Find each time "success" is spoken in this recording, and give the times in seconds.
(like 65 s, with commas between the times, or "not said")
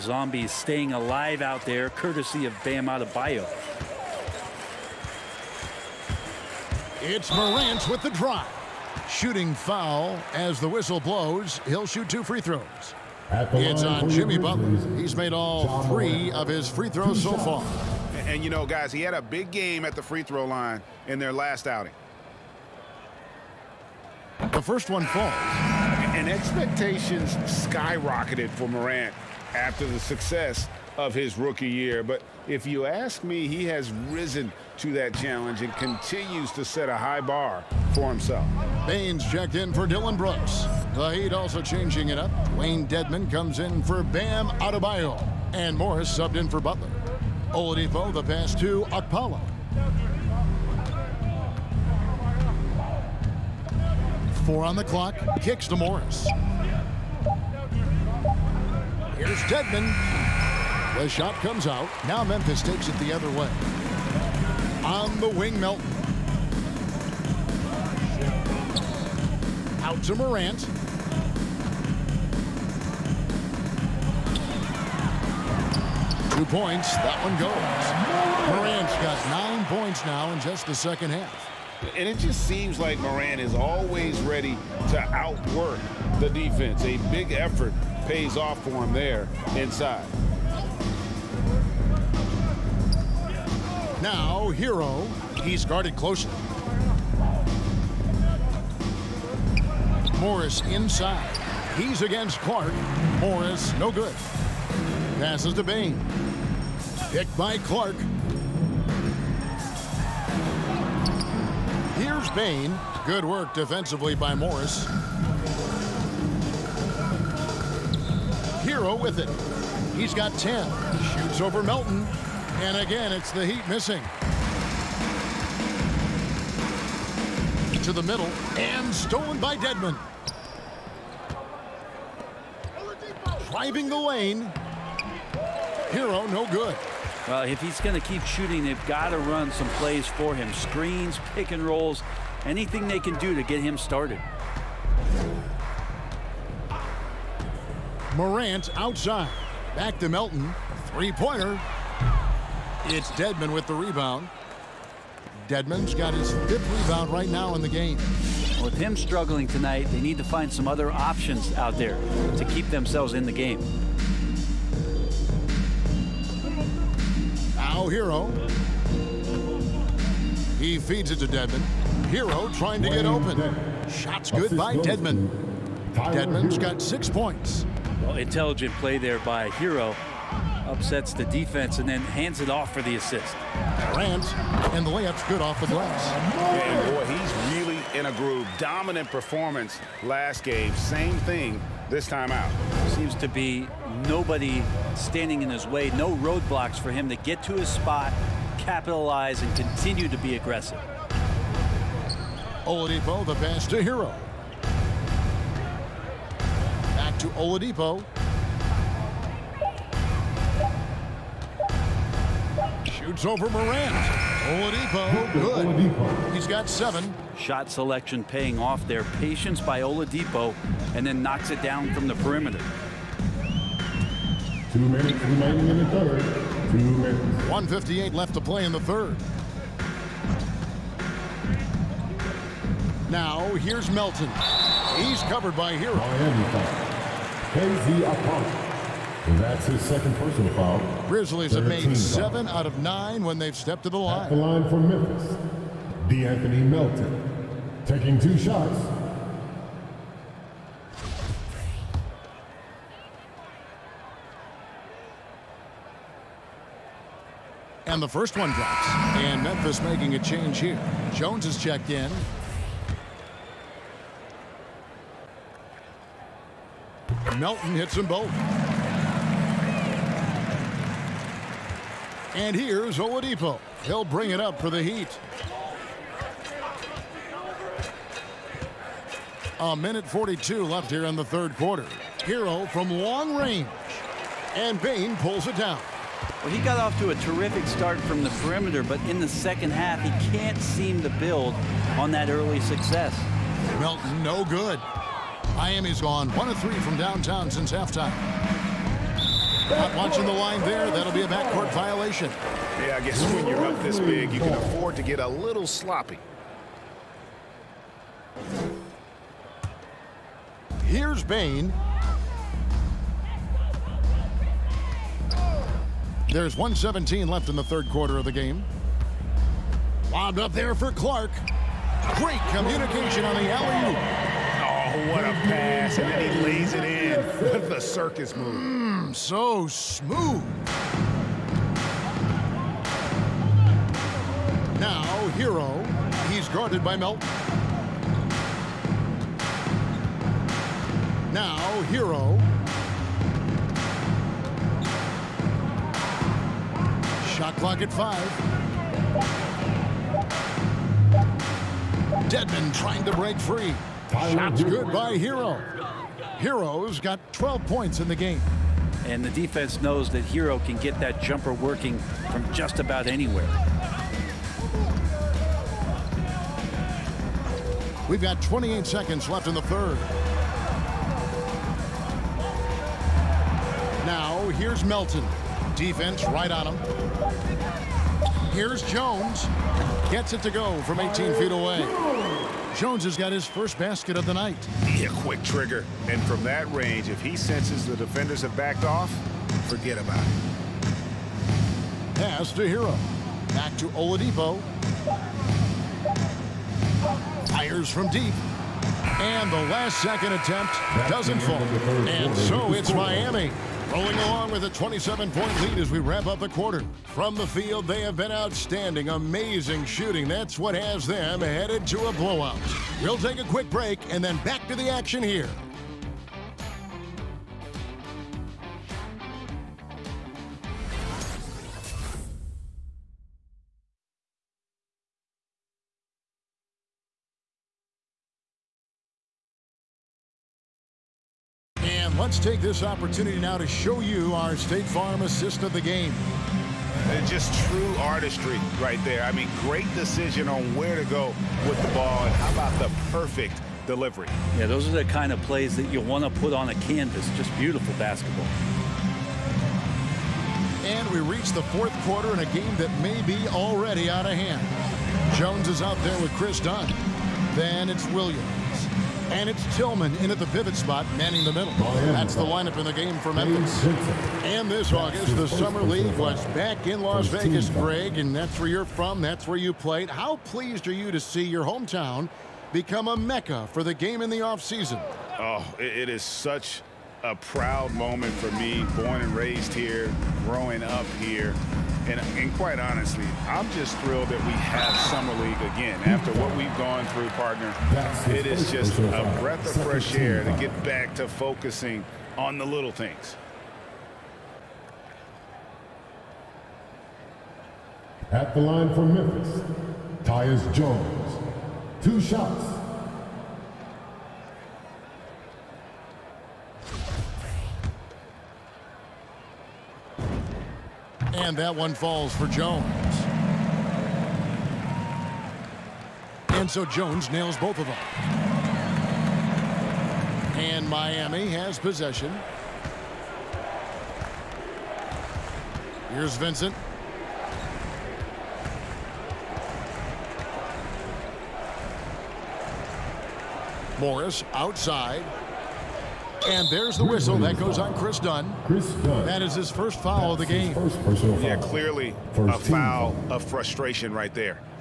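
29 s, 292 s.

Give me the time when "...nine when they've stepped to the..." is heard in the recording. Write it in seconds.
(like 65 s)
242 s.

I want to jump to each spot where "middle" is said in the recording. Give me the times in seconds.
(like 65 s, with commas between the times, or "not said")
128 s, 461 s.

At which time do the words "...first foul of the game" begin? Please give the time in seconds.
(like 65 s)
539 s.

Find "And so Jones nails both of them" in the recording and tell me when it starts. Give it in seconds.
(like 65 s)
516 s.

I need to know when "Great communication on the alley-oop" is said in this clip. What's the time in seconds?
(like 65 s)
322 s.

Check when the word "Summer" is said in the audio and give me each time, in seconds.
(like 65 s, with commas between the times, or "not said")
465 s, 485 s.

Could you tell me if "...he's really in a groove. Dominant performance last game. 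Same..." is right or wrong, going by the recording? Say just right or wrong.
right.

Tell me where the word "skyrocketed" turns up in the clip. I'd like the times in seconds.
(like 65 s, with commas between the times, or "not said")
27 s.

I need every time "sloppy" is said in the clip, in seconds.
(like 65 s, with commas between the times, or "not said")
305 s.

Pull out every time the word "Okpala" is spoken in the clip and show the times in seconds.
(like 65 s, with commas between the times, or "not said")
48 s, 238 s.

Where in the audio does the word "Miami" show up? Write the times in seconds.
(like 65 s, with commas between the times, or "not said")
295 s, 402 s, 520 s.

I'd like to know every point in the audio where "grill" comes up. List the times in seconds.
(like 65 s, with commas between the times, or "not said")
not said.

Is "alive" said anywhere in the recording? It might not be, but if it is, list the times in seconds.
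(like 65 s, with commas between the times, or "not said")
0 s.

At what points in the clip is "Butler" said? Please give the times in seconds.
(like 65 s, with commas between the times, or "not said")
14 s, 46 s.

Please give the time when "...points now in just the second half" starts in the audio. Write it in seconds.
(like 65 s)
79 s.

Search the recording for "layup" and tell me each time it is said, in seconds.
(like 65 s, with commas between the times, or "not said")
184 s.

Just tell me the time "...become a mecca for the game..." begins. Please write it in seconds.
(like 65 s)
472 s.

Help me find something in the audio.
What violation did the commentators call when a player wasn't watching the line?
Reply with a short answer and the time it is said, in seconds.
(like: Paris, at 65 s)
Backcourt violation, at 301 s.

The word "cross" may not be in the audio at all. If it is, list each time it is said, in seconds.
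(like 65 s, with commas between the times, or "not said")
not said.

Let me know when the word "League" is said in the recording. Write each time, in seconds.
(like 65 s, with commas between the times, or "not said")
465 s, 485 s.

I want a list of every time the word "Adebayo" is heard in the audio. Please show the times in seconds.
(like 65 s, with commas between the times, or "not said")
2 s, 44 s.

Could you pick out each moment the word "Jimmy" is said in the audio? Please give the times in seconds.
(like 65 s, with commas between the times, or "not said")
14 s.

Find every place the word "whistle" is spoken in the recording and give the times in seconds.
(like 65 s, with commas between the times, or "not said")
10 s, 537 s.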